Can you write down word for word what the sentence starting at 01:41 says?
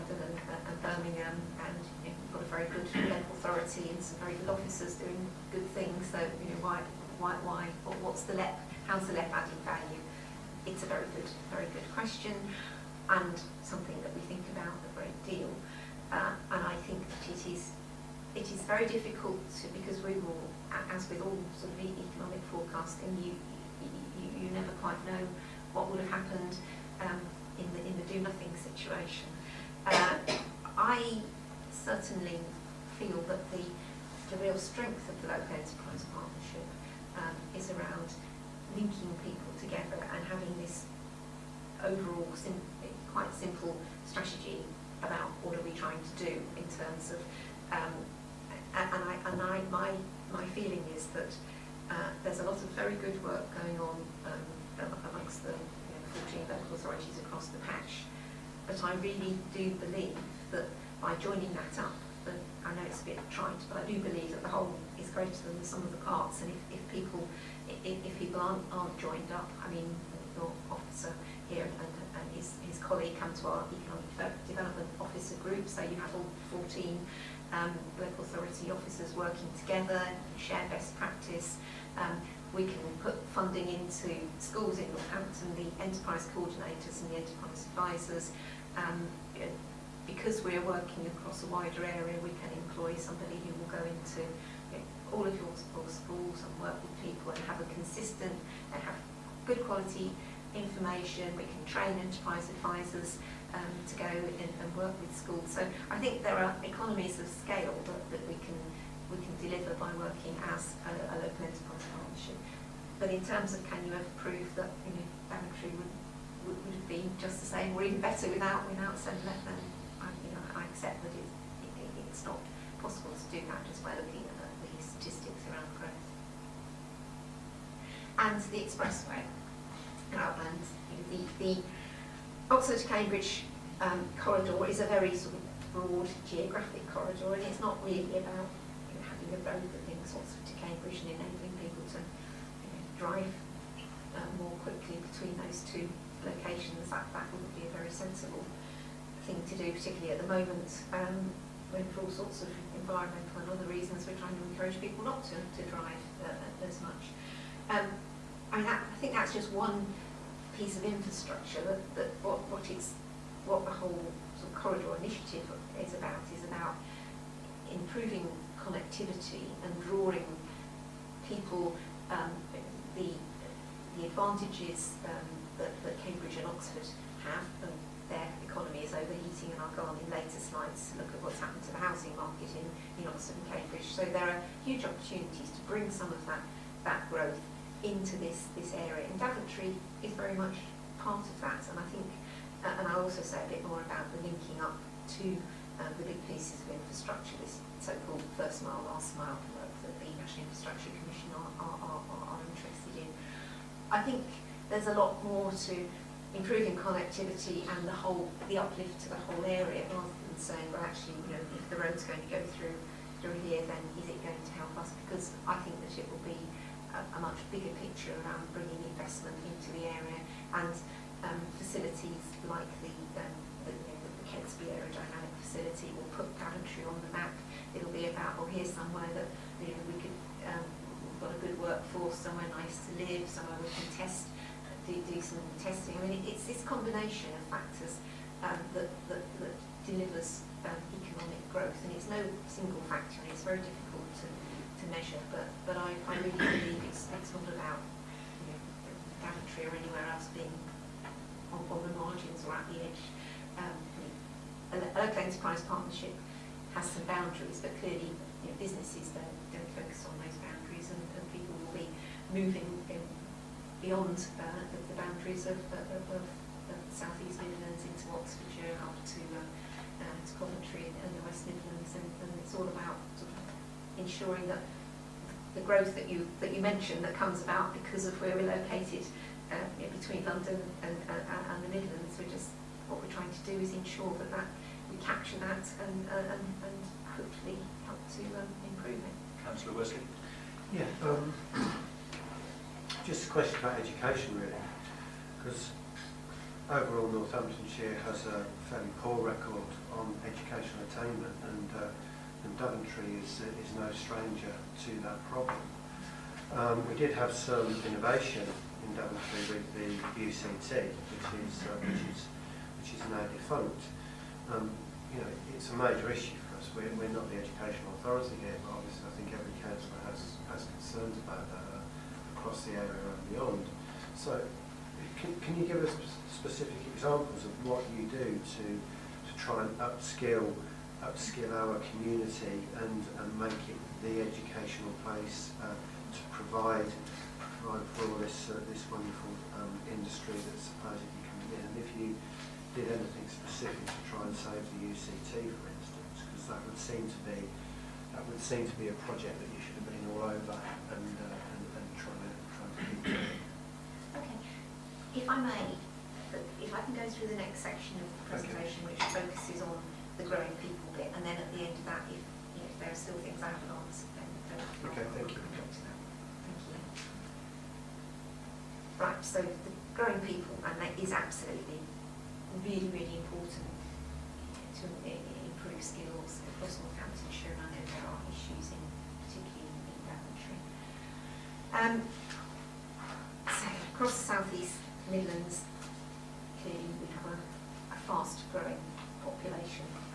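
We can train enterprise advisors um, to go and, and, work with schools.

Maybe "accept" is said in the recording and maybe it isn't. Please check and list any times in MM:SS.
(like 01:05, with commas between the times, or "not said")
02:00.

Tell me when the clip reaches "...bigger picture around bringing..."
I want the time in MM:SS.
03:37.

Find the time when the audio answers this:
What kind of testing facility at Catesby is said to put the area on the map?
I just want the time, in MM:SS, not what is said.
03:44.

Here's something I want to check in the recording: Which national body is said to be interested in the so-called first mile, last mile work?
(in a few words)
National Infrastructure Commission.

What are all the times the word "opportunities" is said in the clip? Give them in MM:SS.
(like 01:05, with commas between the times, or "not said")
03:04.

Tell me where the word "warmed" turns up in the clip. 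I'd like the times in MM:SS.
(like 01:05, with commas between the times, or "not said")
not said.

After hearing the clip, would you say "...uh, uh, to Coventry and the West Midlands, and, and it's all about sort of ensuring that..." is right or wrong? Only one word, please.
right.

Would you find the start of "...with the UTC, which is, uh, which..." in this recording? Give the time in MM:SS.
05:09.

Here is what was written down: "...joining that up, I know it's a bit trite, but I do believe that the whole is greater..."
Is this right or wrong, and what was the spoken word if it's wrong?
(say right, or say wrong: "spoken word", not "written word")
right.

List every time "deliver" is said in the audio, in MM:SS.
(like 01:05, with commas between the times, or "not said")
01:49, 03:59.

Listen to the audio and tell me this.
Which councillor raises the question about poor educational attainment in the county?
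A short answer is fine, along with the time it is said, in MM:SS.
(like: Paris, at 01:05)
Councillor Wesley, at 04:49.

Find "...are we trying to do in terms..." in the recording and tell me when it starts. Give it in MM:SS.
00:45.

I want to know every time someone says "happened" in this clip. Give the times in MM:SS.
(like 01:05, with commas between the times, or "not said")
00:26, 03:01.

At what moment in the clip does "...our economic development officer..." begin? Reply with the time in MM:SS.
01:13.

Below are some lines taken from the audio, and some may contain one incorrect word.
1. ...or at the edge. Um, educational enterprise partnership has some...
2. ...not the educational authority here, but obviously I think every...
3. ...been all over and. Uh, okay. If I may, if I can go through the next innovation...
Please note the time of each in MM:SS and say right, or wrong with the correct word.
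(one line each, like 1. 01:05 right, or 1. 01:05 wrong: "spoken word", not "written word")
1. 04:12 wrong: "local", not "educational"
2. 05:17 right
3. 05:49 wrong: "section", not "innovation".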